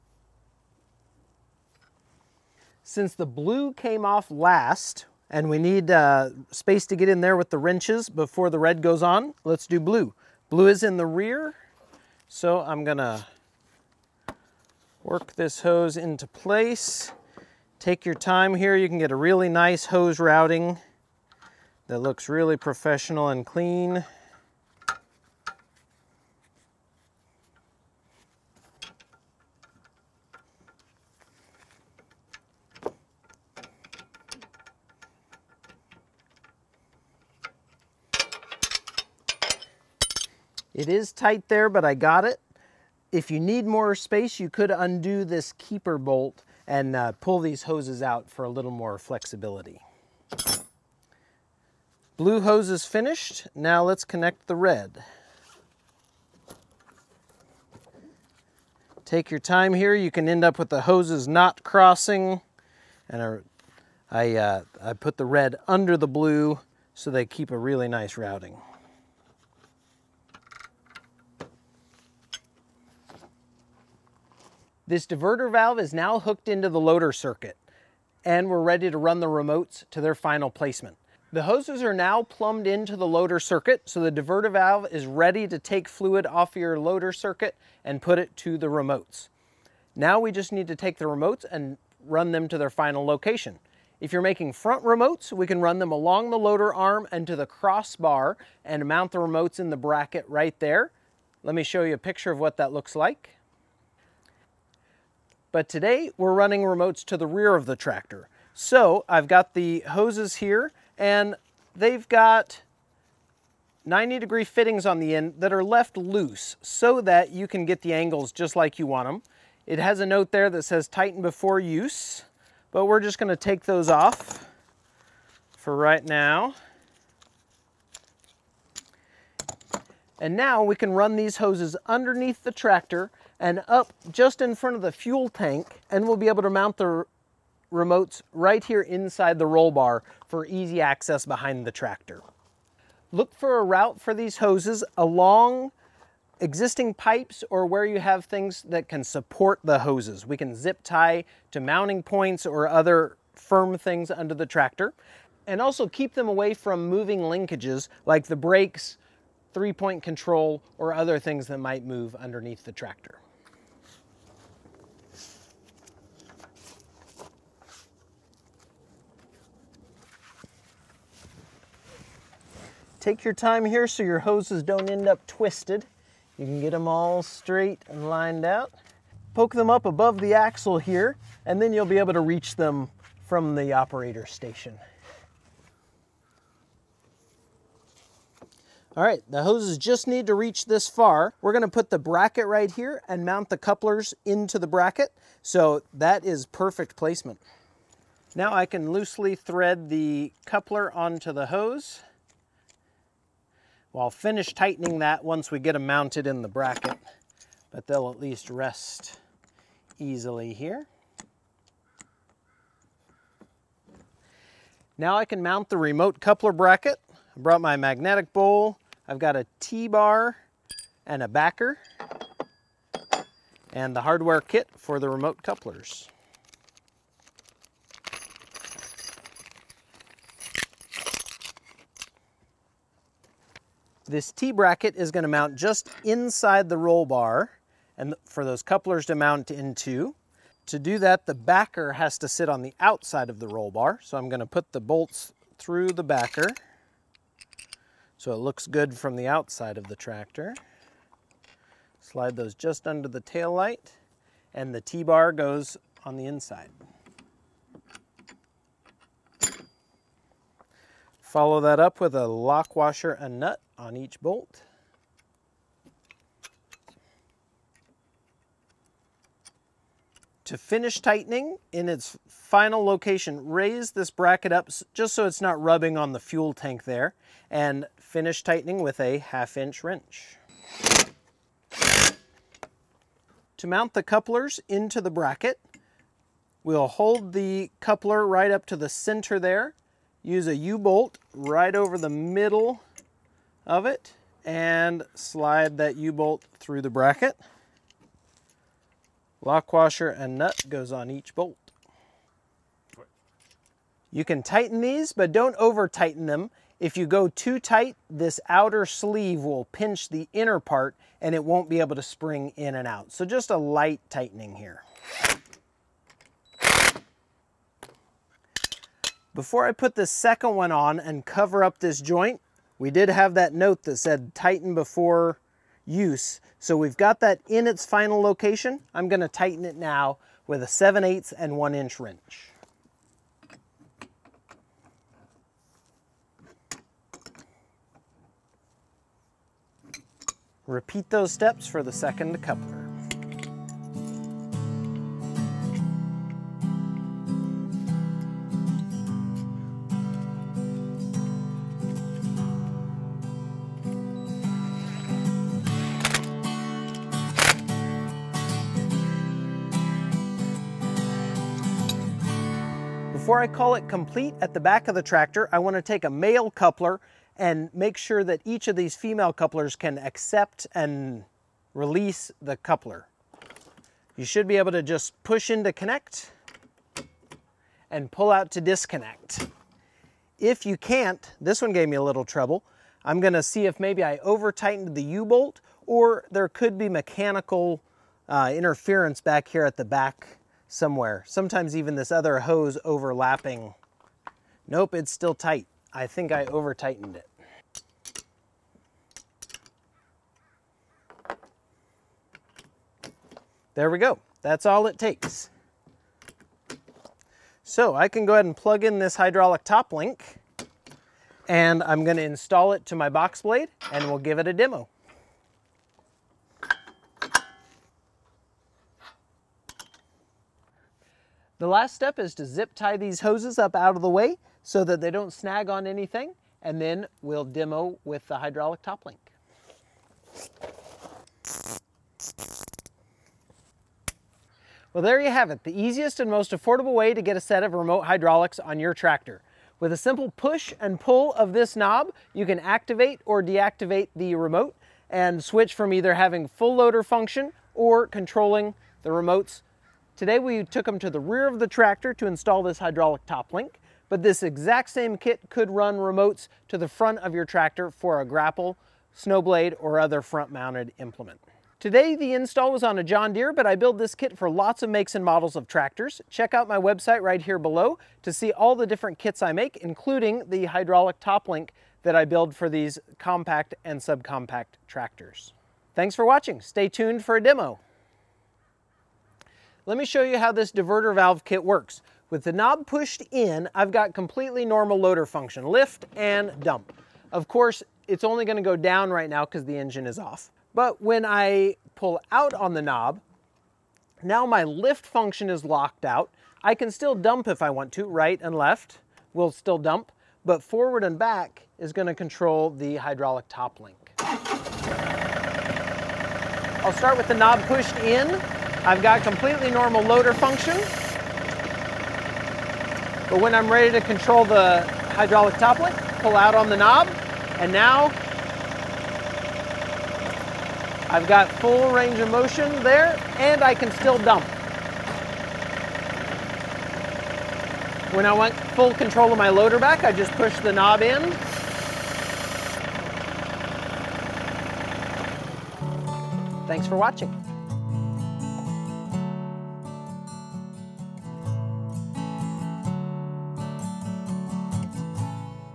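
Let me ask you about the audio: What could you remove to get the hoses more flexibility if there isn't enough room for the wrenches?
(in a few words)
keeper bolt.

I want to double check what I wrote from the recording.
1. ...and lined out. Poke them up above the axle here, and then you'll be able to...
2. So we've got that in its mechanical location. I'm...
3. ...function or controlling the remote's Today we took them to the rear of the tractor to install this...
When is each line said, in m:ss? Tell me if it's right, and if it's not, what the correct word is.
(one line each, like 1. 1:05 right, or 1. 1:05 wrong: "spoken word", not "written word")
1. 2:57 right
2. 5:26 wrong: "final", not "mechanical"
3. 7:27 right.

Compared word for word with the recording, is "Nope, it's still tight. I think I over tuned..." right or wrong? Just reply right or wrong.
wrong.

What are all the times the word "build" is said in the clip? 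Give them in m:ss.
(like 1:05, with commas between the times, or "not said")
7:43, 7:52.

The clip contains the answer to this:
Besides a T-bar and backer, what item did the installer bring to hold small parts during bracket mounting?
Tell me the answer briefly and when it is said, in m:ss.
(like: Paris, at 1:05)
magnetic bowl, at 3:37.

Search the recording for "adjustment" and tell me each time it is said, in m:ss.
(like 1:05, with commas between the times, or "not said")
not said.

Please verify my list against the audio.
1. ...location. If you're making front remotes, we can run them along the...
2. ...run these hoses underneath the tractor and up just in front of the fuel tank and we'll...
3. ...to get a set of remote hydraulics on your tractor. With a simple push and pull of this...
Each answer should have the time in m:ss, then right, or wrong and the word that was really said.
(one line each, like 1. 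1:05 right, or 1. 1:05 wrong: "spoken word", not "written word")
1. 1:33 right
2. 2:10 right
3. 7:17 right.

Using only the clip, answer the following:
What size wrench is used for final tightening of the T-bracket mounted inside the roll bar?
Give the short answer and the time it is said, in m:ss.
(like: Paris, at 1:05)
1/2 inch, at 4:39.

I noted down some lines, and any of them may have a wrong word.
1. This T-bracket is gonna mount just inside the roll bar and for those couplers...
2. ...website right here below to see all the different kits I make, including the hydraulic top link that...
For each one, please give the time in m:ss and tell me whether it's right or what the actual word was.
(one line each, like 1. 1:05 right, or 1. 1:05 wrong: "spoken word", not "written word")
1. 3:54 right
2. 7:46 right.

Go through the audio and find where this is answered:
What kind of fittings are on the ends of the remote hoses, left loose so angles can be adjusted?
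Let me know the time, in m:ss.
1:53.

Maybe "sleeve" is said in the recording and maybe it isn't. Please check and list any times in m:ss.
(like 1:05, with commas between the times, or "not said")
5:08.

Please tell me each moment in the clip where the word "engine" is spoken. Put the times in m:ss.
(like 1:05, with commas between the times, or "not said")
8:09.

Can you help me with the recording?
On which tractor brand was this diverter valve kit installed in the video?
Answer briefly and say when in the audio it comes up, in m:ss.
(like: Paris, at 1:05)
John Deere, at 7:43.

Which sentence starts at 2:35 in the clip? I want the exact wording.
And also keep them away from moving linkages like the brakes, three-point control, or other things that might move underneath the tractor.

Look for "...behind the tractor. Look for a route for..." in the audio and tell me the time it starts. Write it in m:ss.
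2:21.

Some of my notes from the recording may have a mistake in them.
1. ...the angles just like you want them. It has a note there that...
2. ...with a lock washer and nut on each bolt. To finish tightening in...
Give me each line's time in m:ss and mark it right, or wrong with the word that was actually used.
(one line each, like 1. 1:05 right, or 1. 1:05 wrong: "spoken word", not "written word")
1. 1:57 right
2. 4:22 right.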